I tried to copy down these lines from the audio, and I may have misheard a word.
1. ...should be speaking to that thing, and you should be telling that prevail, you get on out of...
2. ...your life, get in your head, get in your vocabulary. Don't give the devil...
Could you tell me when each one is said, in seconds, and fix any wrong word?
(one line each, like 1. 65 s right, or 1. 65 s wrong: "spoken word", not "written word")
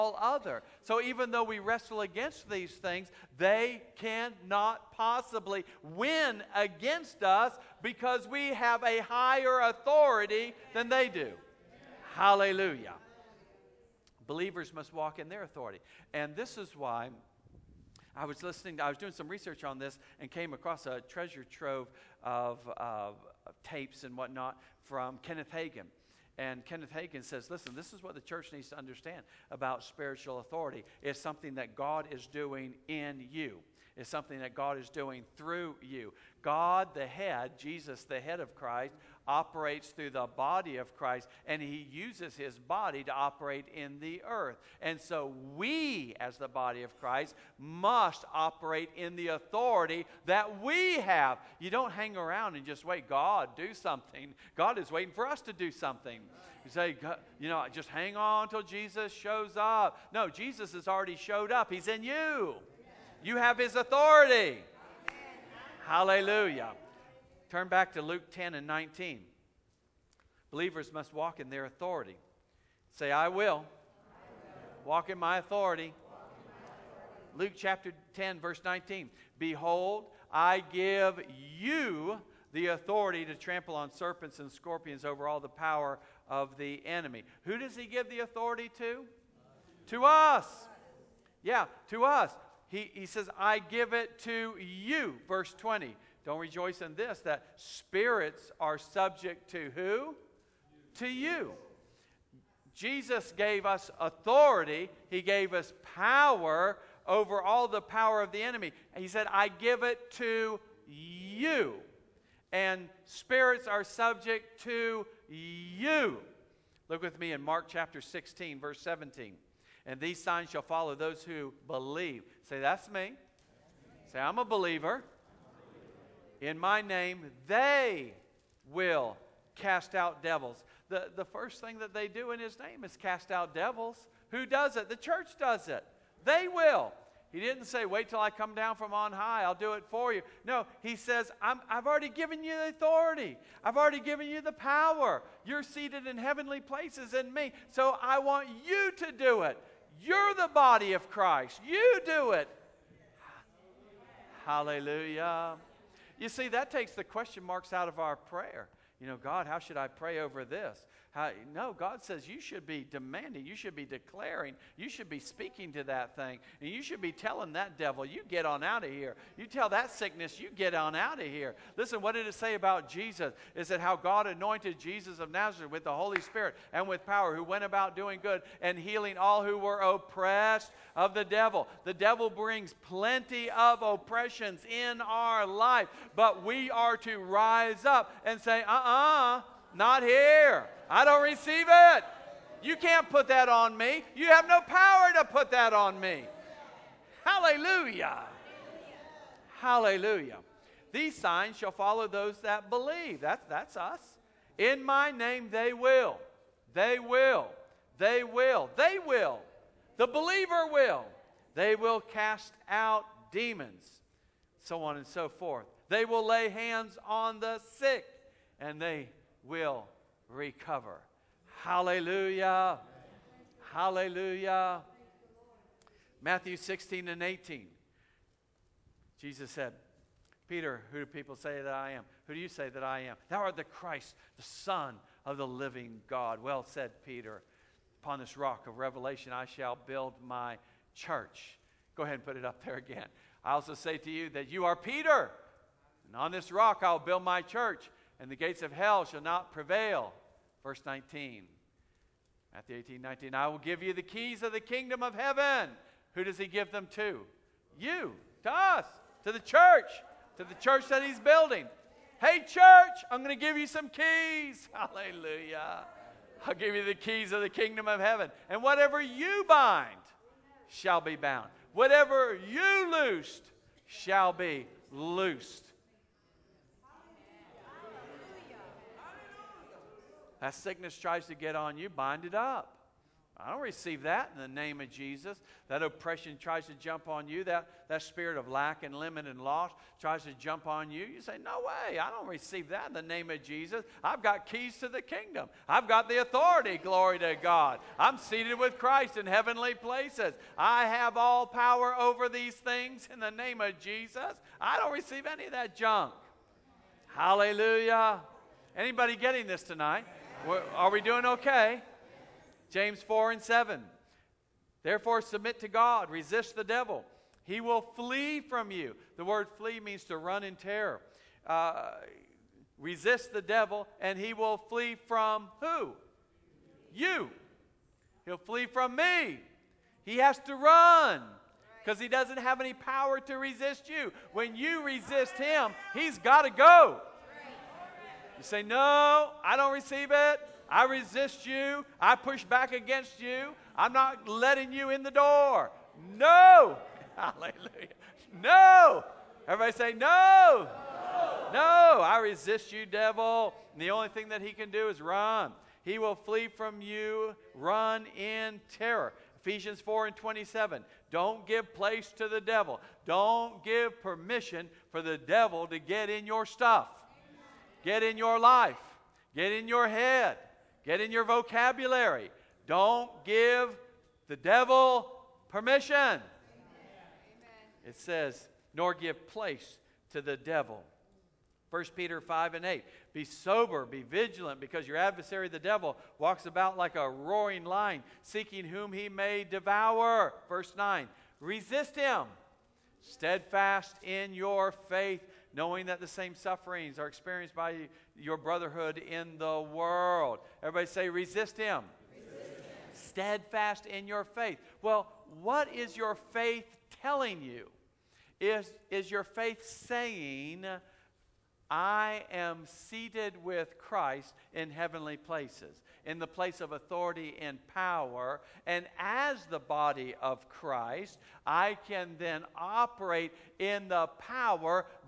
1. 164 s wrong: "devil", not "prevail"
2. 368 s right.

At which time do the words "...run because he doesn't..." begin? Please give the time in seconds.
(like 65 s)
330 s.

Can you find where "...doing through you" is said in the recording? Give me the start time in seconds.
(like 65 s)
34 s.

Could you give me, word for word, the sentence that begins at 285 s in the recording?
That oppression tries to jump on you.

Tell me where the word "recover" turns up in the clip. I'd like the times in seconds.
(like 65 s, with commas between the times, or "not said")
220 s.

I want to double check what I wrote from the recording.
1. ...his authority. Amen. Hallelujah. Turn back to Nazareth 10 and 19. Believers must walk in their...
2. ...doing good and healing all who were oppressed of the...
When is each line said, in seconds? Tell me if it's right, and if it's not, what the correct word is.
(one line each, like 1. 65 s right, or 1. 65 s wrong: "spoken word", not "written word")
1. 63 s wrong: "Luke", not "Nazareth"
2. 177 s right.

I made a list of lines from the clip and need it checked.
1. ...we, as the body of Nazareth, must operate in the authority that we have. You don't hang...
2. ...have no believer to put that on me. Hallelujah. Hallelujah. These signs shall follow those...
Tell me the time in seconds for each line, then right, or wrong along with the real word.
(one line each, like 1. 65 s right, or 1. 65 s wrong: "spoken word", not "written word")
1. 45 s wrong: "Christ", not "Nazareth"
2. 194 s wrong: "power", not "believer".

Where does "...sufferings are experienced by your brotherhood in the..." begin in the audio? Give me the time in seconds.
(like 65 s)
396 s.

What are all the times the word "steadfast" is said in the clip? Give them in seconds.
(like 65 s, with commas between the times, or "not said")
393 s, 402 s.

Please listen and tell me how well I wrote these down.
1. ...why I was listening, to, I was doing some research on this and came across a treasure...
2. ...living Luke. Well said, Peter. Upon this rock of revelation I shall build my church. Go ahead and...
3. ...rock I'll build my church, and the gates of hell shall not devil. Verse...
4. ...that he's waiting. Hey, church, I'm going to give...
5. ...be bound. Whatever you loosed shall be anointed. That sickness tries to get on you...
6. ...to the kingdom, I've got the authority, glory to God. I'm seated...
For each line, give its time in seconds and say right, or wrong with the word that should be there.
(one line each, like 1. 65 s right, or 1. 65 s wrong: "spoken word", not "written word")
1. 16 s right
2. 235 s wrong: "God", not "Luke"
3. 246 s wrong: "prevail", not "devil"
4. 260 s wrong: "building", not "waiting"
5. 271 s wrong: "loosed", not "anointed"
6. 294 s right.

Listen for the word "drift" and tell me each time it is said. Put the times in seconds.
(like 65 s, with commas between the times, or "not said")
not said.